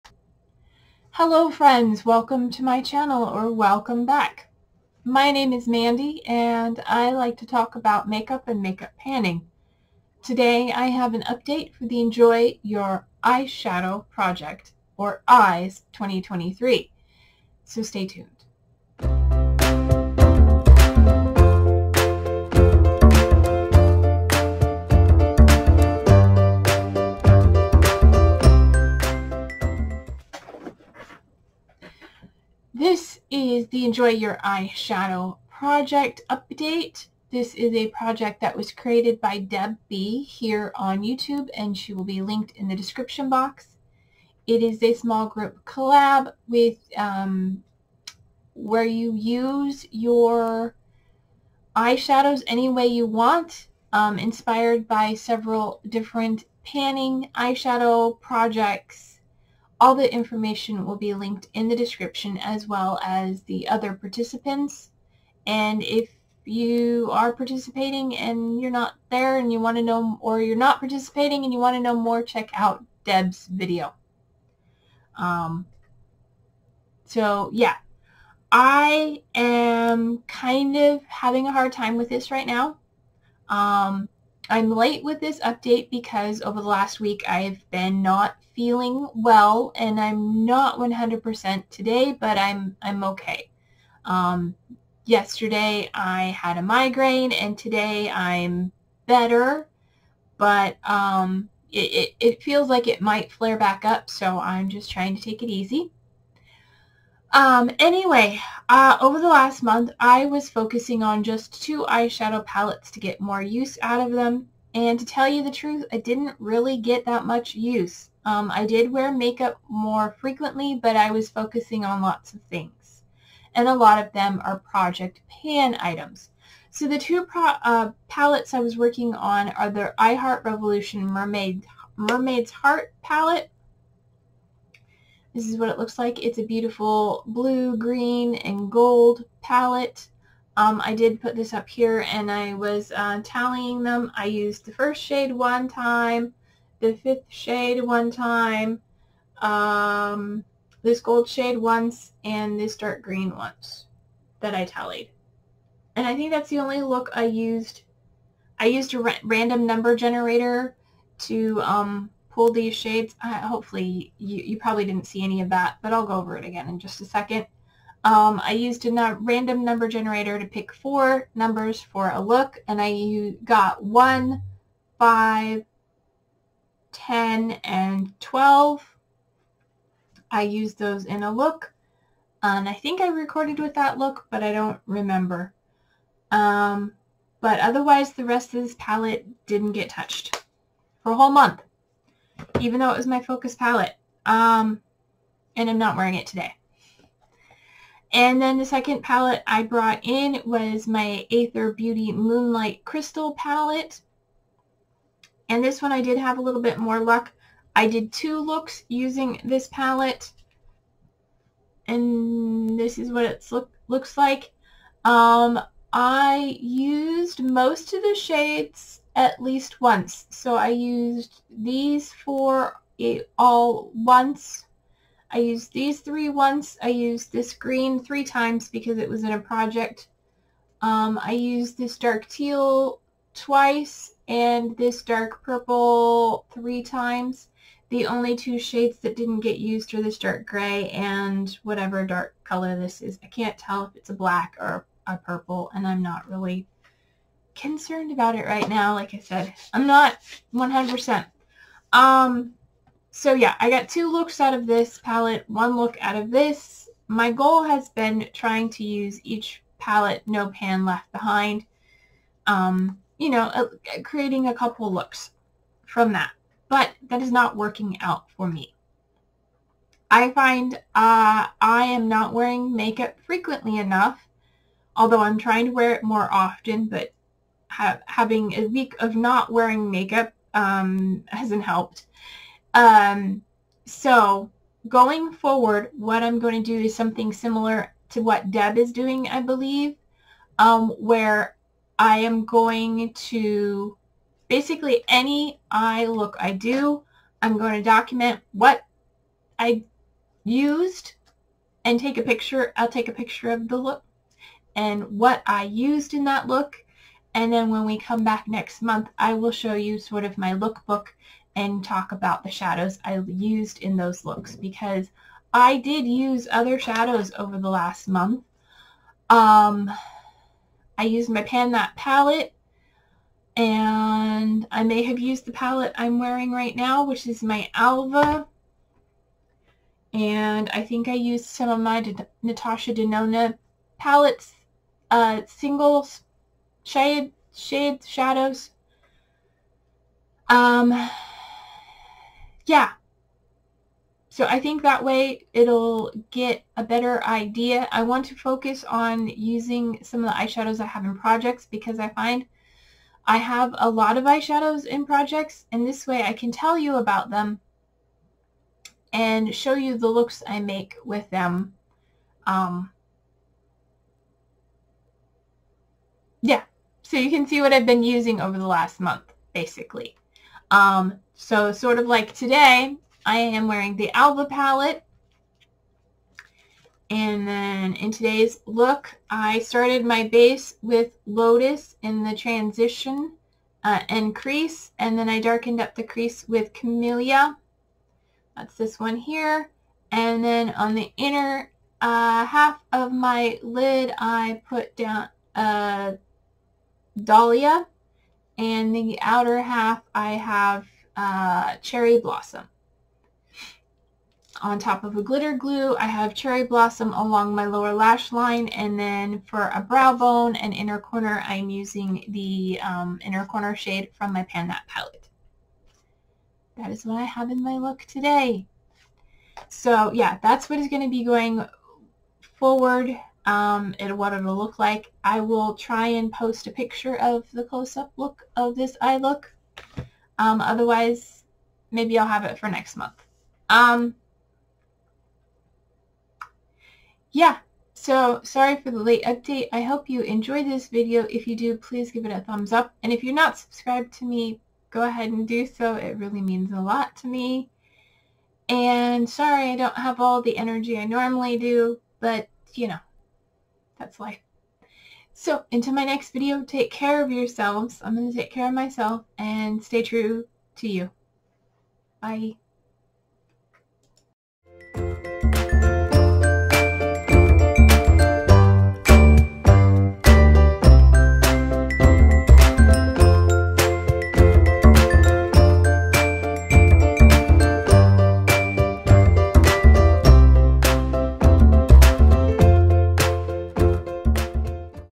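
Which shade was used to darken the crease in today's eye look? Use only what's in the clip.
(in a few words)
Camellia.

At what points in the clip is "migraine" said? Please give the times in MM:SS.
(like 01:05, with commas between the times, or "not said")
01:36.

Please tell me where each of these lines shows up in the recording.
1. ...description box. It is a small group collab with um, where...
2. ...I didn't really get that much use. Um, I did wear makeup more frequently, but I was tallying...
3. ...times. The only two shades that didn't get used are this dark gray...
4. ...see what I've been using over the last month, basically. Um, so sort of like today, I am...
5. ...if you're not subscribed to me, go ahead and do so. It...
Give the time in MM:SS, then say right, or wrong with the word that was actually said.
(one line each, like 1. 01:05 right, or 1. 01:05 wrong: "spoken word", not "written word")
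1. 00:42 right
2. 01:55 wrong: "focusing", not "tallying"
3. 03:56 right
4. 06:07 right
5. 07:23 right.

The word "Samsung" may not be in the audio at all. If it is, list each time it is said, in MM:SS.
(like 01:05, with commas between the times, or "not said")
not said.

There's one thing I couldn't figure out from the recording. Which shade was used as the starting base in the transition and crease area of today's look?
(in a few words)
Lotus.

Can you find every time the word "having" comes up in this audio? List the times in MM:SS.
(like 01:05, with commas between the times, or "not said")
01:21, 04:38.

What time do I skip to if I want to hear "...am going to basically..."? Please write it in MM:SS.
04:52.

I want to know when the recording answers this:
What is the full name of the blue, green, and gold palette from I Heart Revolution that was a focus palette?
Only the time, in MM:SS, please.
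02:11.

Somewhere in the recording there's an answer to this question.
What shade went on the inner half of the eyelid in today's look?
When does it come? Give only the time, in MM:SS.
06:37.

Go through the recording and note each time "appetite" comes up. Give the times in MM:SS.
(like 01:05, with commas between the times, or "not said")
not said.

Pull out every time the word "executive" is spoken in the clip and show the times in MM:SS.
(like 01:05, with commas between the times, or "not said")
not said.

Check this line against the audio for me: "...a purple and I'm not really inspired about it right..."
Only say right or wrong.
wrong.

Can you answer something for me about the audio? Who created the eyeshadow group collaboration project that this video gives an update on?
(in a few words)
Deb B.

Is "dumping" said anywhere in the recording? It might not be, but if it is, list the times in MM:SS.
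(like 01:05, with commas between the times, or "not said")
not said.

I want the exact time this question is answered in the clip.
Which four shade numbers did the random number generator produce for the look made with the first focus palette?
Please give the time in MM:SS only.
02:53.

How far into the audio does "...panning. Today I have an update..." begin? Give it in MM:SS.
00:08.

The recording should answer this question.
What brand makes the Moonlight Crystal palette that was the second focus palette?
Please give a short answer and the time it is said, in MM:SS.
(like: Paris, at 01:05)
Aether Beauty, at 03:21.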